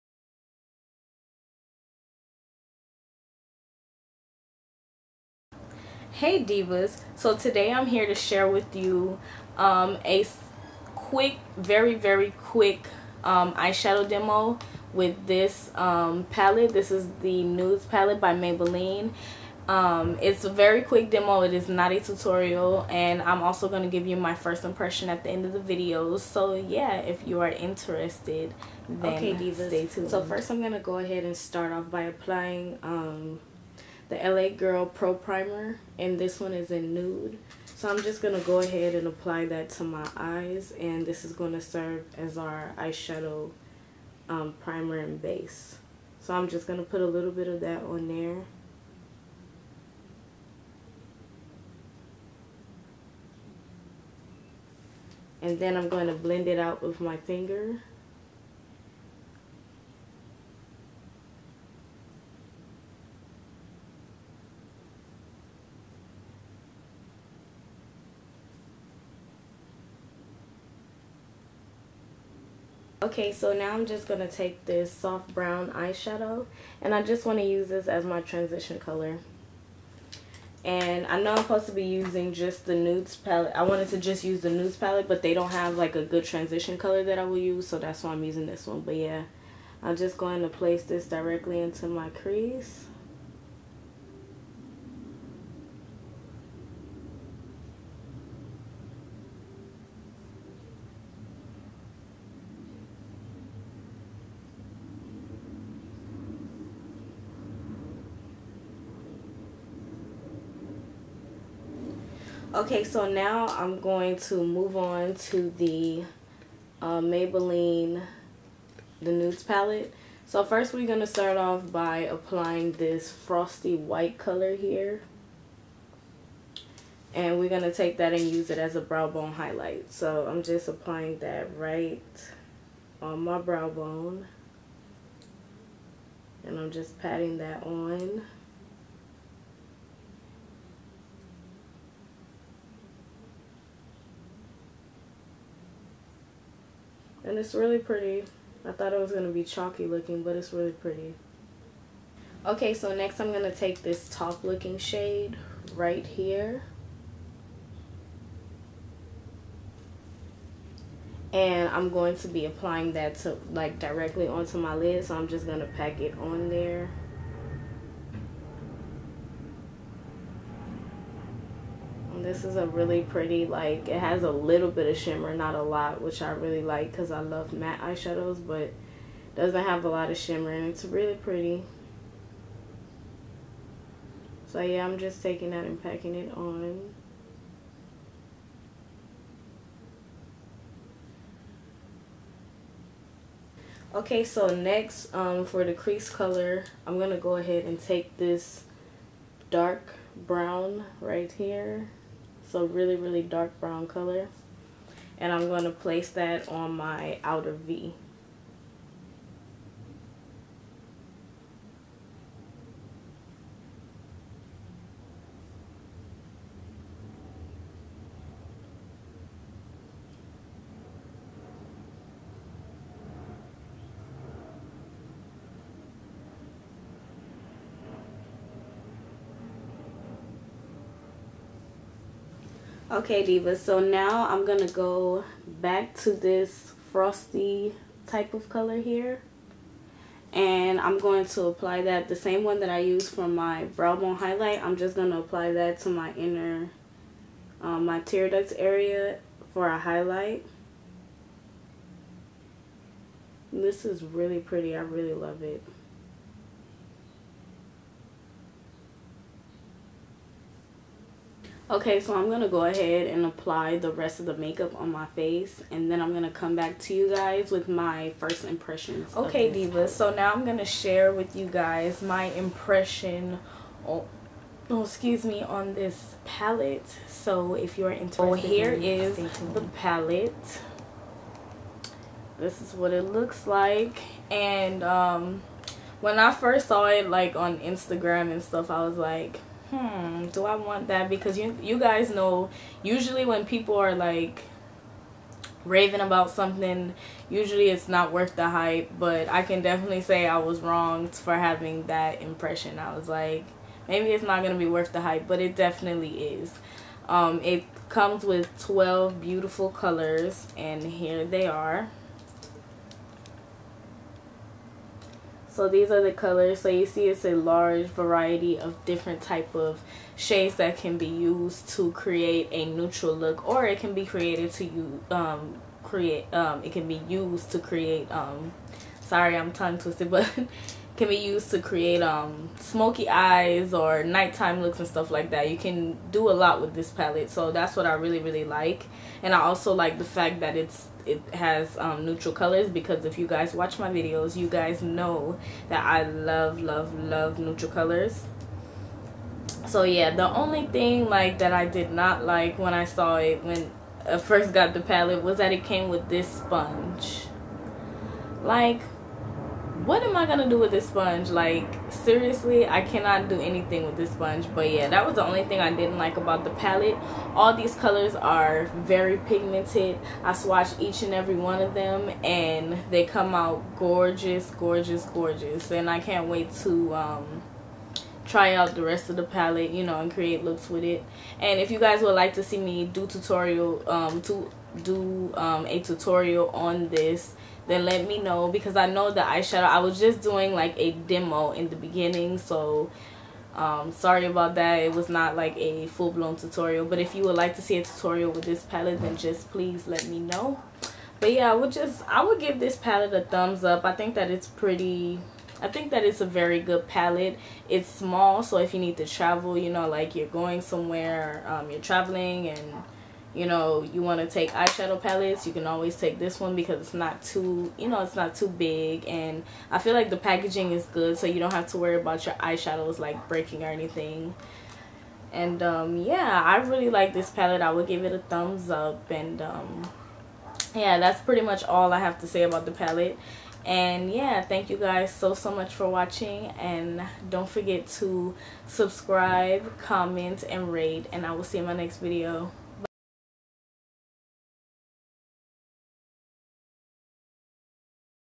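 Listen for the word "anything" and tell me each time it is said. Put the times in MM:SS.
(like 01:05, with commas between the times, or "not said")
06:03, 07:03.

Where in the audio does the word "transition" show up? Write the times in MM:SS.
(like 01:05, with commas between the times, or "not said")
01:18, 01:26.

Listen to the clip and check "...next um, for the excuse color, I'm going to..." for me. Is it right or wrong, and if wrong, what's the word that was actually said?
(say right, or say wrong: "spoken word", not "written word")
wrong: "crease", not "excuse".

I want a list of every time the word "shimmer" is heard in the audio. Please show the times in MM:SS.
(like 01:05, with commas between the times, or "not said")
02:54, 03:00.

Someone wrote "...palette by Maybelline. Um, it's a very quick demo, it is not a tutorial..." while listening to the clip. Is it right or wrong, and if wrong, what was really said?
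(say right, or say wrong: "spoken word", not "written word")
right.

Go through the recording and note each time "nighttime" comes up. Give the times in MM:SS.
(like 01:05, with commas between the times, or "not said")
05:34.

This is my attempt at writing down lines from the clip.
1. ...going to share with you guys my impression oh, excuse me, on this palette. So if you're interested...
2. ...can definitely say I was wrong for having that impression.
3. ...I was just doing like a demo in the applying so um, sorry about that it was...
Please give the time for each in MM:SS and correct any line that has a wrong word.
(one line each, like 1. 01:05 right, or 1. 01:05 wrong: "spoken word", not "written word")
1. 04:30 right
2. 04:59 right
3. 06:29 wrong: "beginning", not "applying".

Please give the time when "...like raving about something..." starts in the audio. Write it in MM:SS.
04:53.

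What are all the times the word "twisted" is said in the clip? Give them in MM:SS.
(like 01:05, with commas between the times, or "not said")
05:29.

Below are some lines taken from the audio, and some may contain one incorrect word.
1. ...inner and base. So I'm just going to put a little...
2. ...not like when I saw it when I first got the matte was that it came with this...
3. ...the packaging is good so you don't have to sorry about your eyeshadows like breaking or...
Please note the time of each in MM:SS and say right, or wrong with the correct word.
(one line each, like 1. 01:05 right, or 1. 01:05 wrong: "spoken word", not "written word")
1. 00:44 wrong: "primer", not "inner"
2. 05:51 wrong: "palette", not "matte"
3. 07:00 wrong: "worry", not "sorry".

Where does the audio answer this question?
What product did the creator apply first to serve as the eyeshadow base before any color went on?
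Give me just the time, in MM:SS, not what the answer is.
00:34.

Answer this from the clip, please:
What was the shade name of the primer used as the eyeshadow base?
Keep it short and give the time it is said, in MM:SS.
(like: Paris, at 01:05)
nude, at 00:36.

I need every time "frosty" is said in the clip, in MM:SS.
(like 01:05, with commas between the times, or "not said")
02:03, 03:56.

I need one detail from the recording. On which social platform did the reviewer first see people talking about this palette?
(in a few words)
Instagram.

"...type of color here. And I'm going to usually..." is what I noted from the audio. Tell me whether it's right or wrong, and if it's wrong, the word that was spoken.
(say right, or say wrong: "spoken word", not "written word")
wrong: "apply", not "usually".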